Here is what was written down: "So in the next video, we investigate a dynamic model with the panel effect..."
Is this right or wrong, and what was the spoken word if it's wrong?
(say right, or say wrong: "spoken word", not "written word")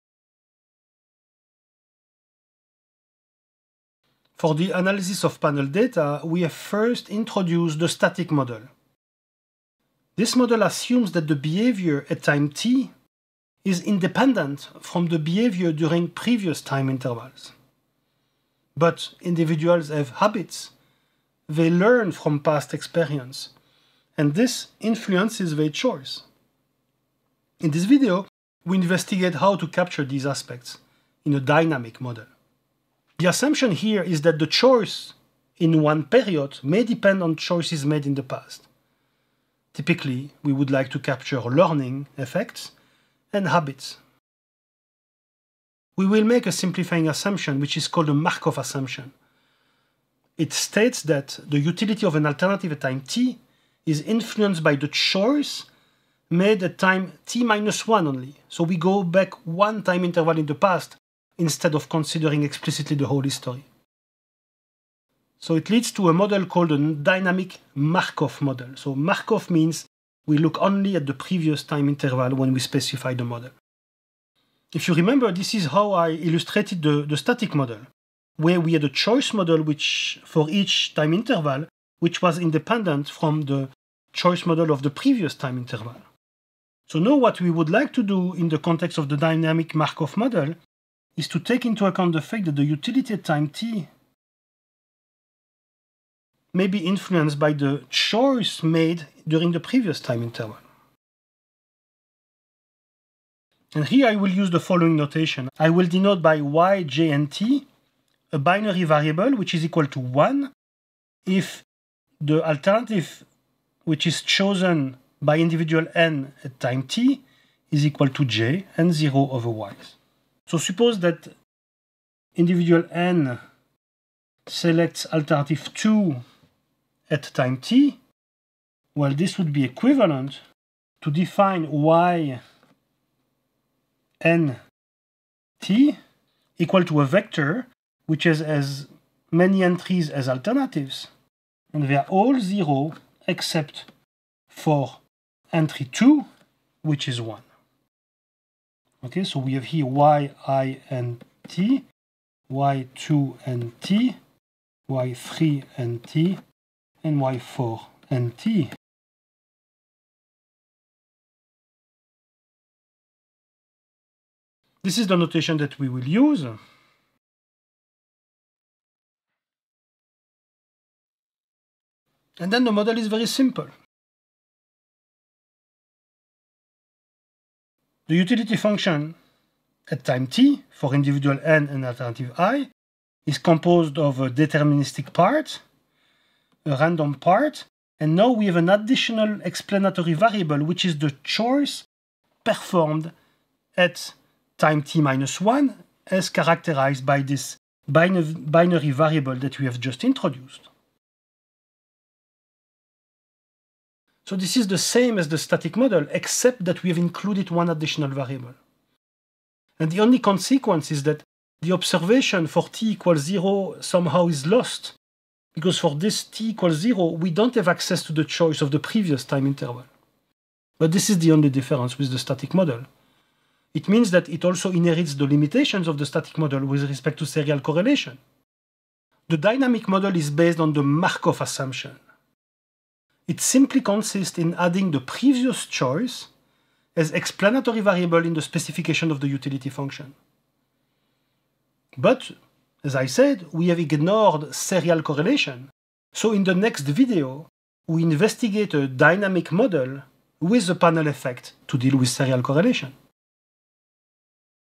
right.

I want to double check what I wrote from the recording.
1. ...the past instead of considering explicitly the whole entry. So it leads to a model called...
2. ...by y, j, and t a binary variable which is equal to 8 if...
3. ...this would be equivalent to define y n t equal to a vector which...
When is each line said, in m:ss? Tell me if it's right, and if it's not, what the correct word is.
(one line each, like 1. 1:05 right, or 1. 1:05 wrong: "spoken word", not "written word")
1. 1:00 wrong: "history", not "entry"
2. 1:46 wrong: "1", not "8"
3. 2:09 right.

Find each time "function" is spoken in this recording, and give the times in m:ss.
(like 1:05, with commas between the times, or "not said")
2:58, 3:59.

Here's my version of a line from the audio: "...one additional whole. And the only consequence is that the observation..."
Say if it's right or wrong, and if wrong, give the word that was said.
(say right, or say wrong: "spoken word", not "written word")
wrong: "variable", not "whole".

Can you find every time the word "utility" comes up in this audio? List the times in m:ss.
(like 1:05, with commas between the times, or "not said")
0:51, 1:32, 2:58, 3:59.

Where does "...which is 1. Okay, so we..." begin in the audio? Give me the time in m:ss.
2:26.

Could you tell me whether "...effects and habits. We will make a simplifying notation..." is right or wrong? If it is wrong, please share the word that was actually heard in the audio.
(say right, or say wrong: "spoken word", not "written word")
wrong: "assumption", not "notation".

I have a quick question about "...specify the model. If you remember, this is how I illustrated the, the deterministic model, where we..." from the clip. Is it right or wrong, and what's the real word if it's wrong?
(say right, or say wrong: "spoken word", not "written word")
wrong: "static", not "deterministic".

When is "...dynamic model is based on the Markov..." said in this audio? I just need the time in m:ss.
3:49.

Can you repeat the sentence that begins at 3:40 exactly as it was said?
But this is the only difference with the static model.